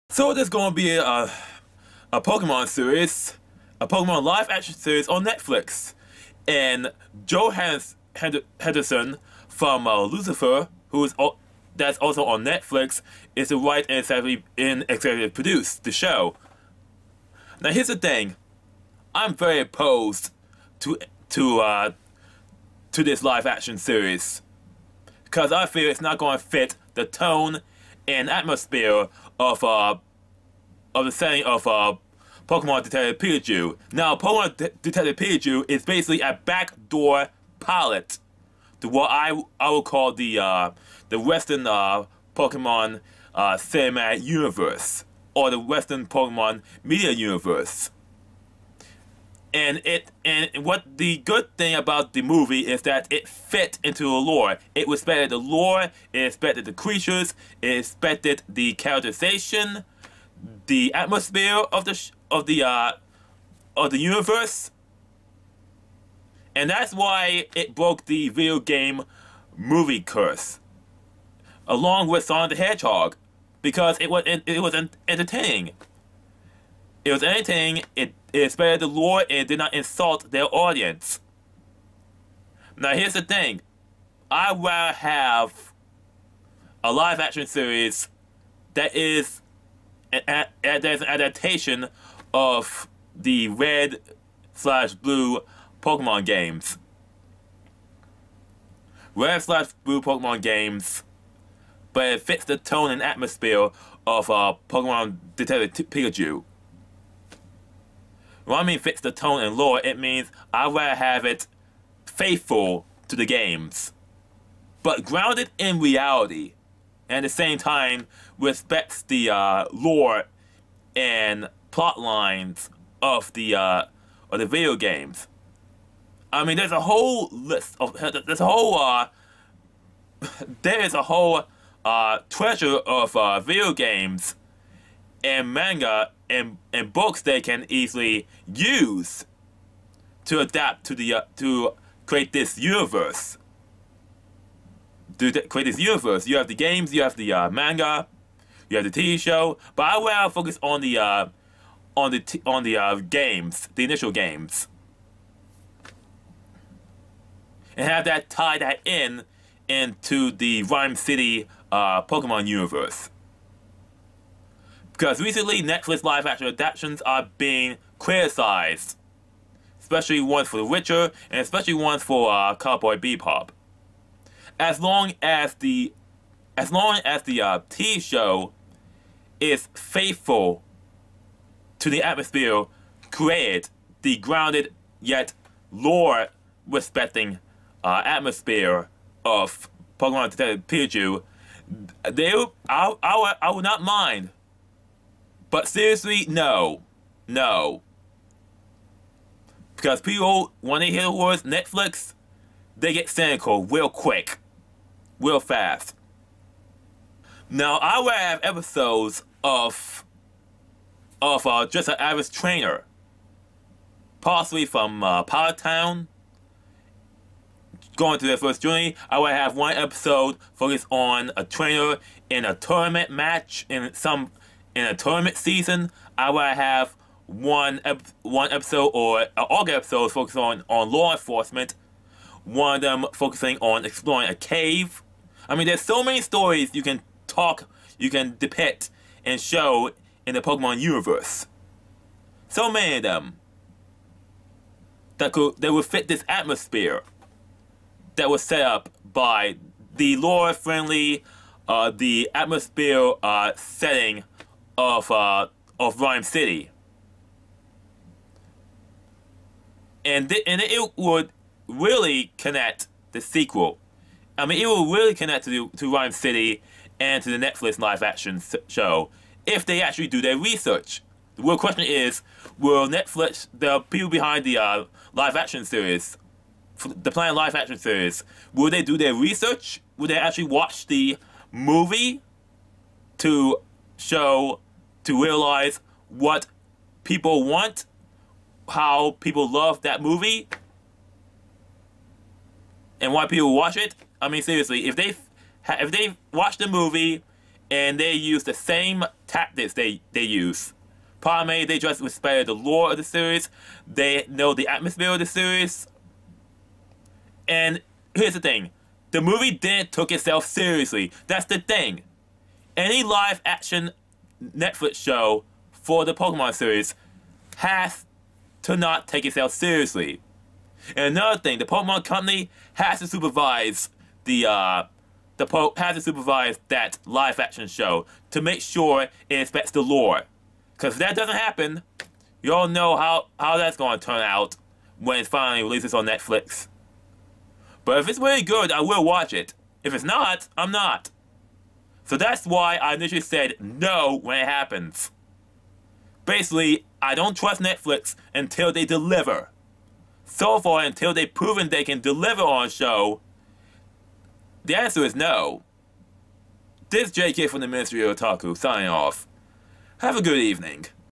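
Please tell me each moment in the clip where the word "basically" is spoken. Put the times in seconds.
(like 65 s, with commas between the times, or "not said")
35 s, 346 s.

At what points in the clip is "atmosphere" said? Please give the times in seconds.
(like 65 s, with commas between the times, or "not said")
28 s, 60 s, 103 s, 182 s, 188 s, 246 s, 252 s, 304 s.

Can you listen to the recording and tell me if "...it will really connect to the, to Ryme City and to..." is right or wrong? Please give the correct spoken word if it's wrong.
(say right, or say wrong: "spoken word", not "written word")
right.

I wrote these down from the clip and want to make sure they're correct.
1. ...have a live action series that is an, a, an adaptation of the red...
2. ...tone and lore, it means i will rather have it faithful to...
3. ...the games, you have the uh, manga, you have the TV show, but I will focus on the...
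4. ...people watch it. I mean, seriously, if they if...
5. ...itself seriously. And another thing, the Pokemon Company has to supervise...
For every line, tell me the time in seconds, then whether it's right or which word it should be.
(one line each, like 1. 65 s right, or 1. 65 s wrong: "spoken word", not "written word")
1. 84 s right
2. 109 s right
3. 146 s right
4. 293 s right
5. 319 s right.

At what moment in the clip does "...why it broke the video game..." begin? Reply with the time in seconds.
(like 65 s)
66 s.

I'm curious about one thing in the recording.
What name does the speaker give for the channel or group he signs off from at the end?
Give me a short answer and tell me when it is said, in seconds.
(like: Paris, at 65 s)
Ministry of Otaku, at 357 s.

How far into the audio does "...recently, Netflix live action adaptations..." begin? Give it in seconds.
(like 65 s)
165 s.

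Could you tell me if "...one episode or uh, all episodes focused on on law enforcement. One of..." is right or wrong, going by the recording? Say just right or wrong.
right.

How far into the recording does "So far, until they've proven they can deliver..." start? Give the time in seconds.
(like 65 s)
350 s.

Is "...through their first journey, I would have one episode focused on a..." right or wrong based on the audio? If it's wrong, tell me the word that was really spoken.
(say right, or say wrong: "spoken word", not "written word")
right.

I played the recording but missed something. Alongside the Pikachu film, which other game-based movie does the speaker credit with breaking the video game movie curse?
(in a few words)
Sonic the Hedgehog.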